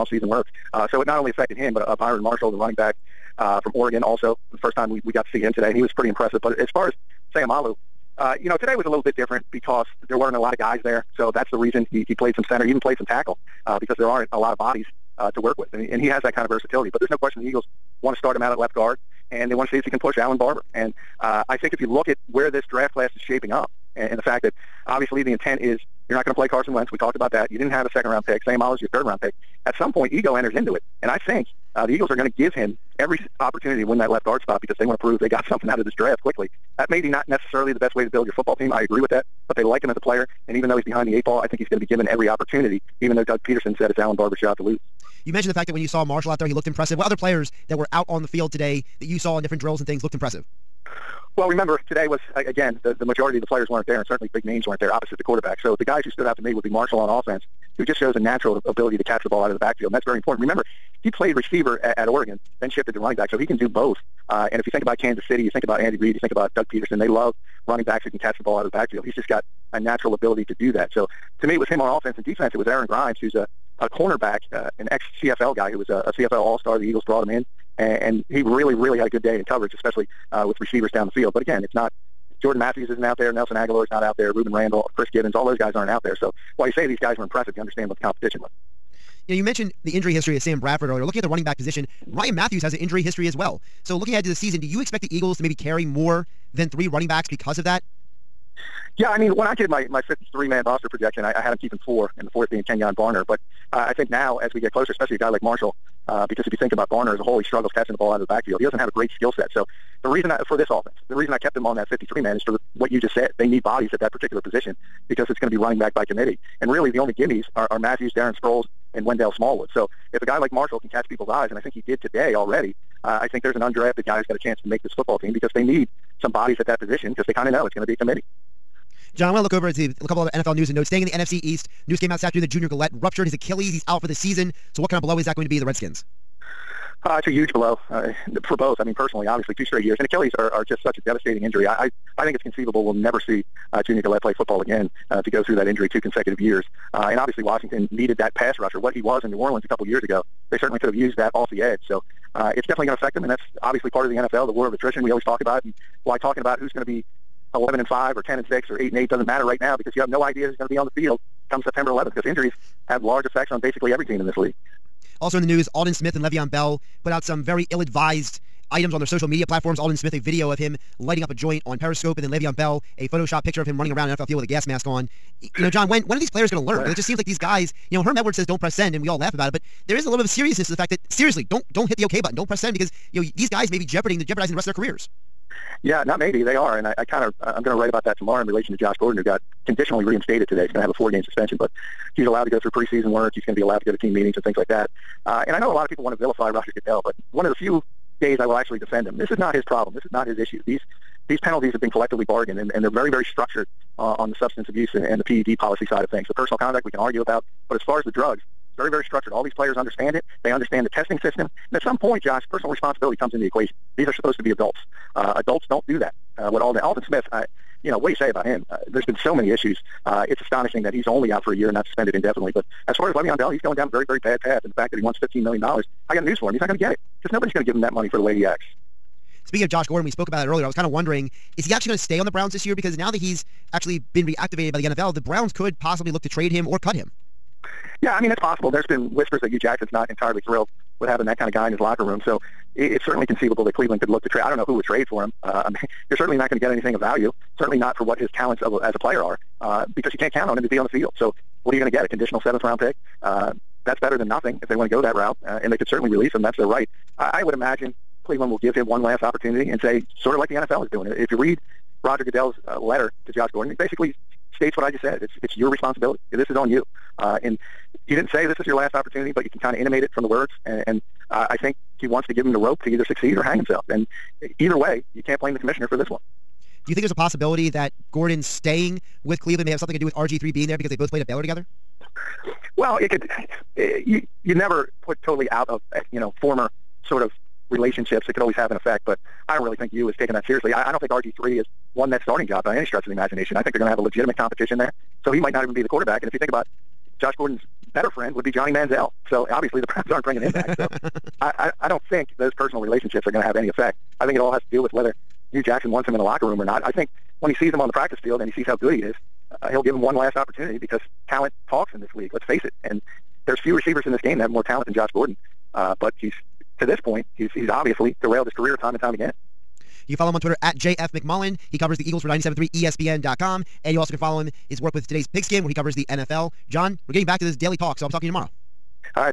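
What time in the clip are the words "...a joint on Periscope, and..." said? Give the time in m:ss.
2:51.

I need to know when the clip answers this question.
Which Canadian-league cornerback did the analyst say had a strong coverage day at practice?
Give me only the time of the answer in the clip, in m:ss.
1:12.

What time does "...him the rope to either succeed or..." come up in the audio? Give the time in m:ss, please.
4:32.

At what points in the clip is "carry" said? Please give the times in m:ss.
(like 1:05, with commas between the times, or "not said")
1:35.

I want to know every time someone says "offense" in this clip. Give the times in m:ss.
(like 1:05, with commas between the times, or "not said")
0:57, 1:11, 1:50.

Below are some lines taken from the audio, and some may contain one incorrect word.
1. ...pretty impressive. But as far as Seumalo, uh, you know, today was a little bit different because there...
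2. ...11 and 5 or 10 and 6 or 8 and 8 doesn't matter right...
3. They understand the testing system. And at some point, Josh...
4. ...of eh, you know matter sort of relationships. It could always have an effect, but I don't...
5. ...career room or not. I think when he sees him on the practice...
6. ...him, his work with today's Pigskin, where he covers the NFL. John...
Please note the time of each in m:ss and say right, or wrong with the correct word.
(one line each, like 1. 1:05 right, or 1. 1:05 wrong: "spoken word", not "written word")
1. 0:05 right
2. 2:37 right
3. 3:30 right
4. 4:45 wrong: "former", not "matter"
5. 5:06 wrong: "locker", not "career"
6. 5:24 right.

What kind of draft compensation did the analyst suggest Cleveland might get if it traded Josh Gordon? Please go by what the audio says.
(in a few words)
Conditional seventh round pick.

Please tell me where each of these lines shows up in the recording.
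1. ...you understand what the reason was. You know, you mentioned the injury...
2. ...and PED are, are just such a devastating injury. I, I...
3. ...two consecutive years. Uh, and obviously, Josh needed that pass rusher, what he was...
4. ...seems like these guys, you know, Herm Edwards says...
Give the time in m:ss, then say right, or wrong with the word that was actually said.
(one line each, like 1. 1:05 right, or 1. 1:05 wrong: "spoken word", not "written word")
1. 1:27 wrong: "competition", not "reason"
2. 2:19 wrong: "Achilles", not "PED"
3. 2:25 wrong: "Washington", not "Josh"
4. 2:57 right.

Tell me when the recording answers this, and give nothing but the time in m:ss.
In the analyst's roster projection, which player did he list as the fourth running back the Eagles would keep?
1:42.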